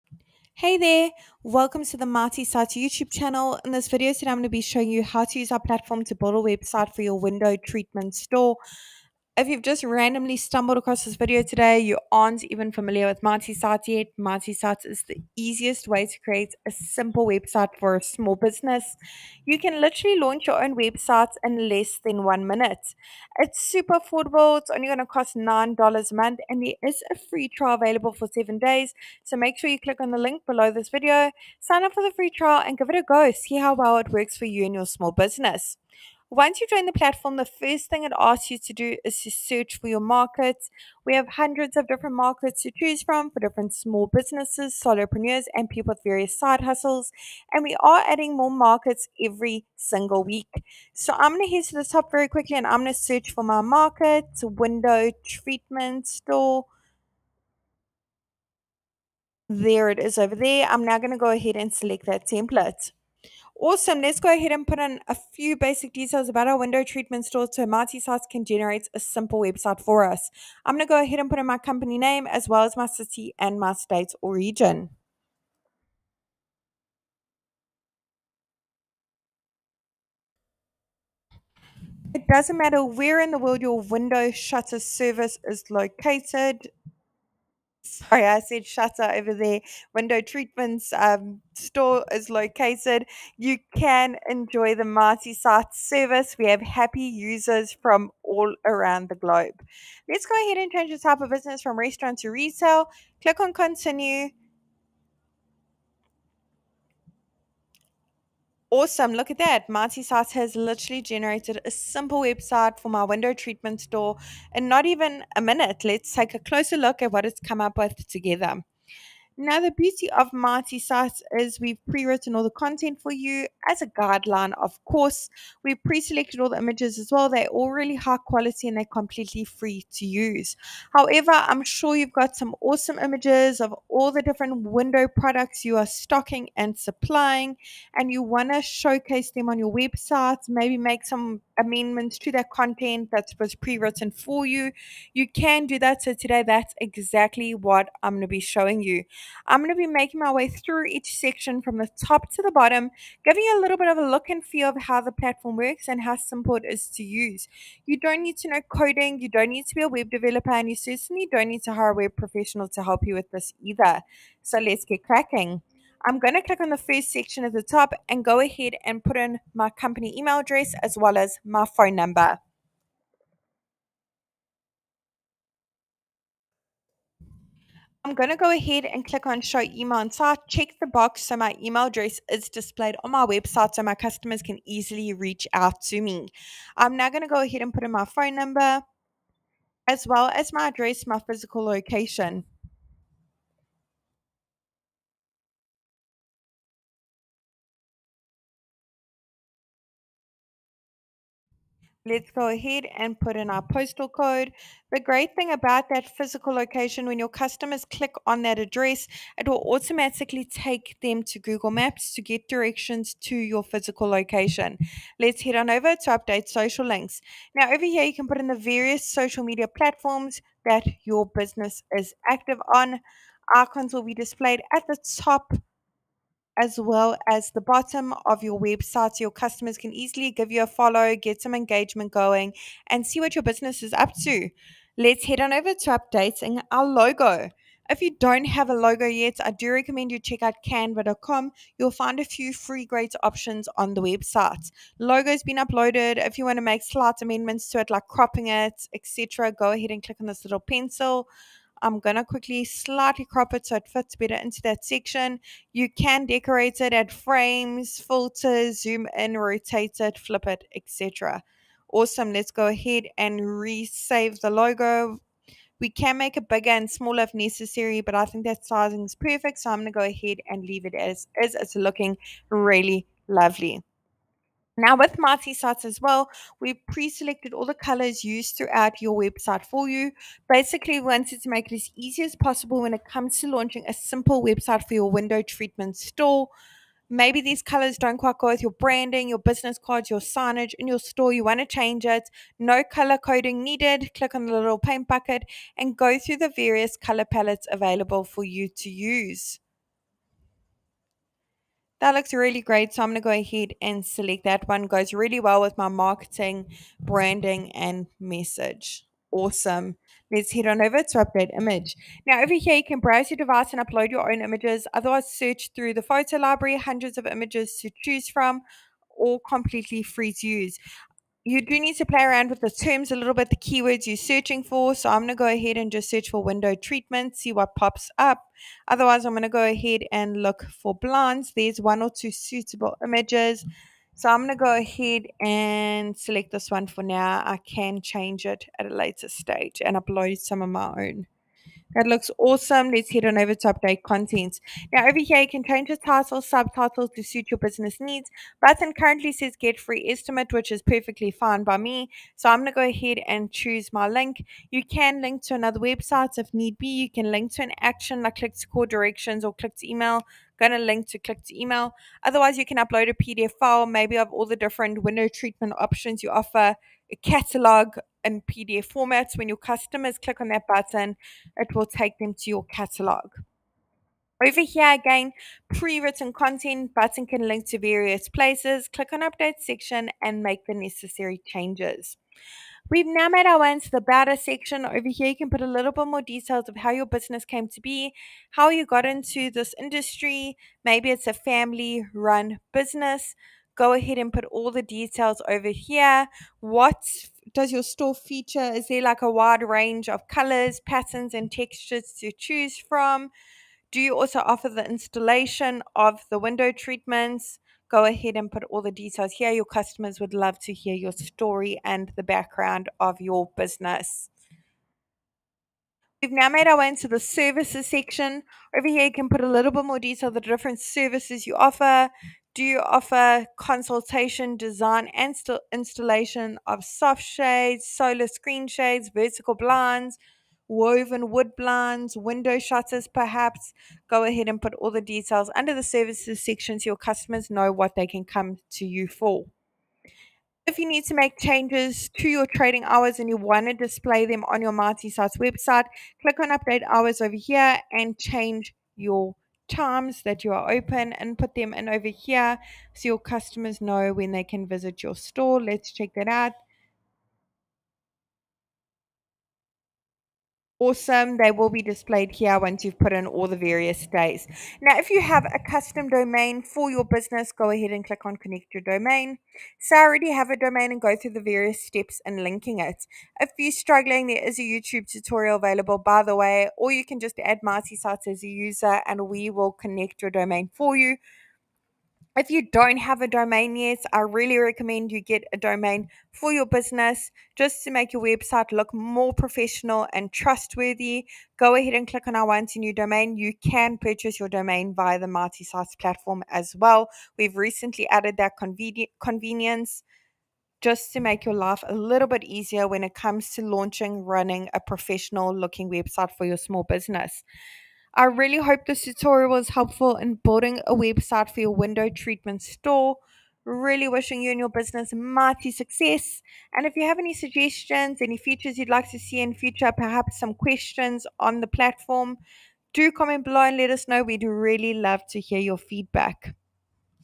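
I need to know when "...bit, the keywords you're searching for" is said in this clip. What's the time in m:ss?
5:23.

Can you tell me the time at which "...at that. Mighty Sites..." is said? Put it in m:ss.
1:49.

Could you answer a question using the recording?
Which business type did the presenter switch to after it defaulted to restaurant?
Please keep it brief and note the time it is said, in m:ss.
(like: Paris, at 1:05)
retail, at 1:42.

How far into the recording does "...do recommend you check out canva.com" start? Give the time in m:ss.
3:59.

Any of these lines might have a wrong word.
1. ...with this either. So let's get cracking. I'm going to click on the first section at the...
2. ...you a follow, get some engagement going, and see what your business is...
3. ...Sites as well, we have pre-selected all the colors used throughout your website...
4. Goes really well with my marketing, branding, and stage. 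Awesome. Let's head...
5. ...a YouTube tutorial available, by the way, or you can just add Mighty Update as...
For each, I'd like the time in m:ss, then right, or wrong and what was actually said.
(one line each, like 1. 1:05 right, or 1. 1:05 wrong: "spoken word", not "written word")
1. 2:43 right
2. 3:50 right
3. 4:35 right
4. 5:04 wrong: "message", not "stage"
5. 7:54 wrong: "Sites", not "Update".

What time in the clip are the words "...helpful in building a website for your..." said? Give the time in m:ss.
8:29.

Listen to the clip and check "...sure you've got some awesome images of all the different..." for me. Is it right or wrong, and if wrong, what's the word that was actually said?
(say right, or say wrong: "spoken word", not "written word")
right.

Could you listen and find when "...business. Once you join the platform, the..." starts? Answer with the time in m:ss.
0:35.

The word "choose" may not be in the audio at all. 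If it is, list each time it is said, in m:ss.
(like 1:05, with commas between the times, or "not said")
0:42, 5:18, 5:53, 6:42.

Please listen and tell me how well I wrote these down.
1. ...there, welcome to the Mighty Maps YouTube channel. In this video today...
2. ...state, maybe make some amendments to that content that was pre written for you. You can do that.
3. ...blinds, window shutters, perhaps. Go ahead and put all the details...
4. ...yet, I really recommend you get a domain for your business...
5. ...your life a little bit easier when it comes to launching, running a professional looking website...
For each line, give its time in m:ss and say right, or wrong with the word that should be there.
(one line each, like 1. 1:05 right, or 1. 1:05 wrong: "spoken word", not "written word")
1. 0:00 wrong: "Sites", not "Maps"
2. 2:19 wrong: "website", not "state"
3. 7:11 right
4. 8:03 right
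5. 8:21 right.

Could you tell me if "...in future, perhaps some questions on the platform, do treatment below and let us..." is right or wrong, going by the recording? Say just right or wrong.
wrong.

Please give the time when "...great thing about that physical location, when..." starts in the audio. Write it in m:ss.
3:24.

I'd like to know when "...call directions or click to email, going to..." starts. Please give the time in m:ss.
5:58.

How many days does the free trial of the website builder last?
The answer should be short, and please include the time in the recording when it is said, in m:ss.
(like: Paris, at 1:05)
7, at 0:28.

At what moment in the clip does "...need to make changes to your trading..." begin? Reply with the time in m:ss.
7:20.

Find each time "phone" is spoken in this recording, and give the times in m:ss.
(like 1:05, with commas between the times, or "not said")
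2:51, 3:08.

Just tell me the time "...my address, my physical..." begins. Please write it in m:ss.
3:10.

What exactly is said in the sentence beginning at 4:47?
Maybe these colors don't quite go with your branding, your business cards, your signage in your store.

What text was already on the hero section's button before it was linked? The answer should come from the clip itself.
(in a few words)
get free estimate.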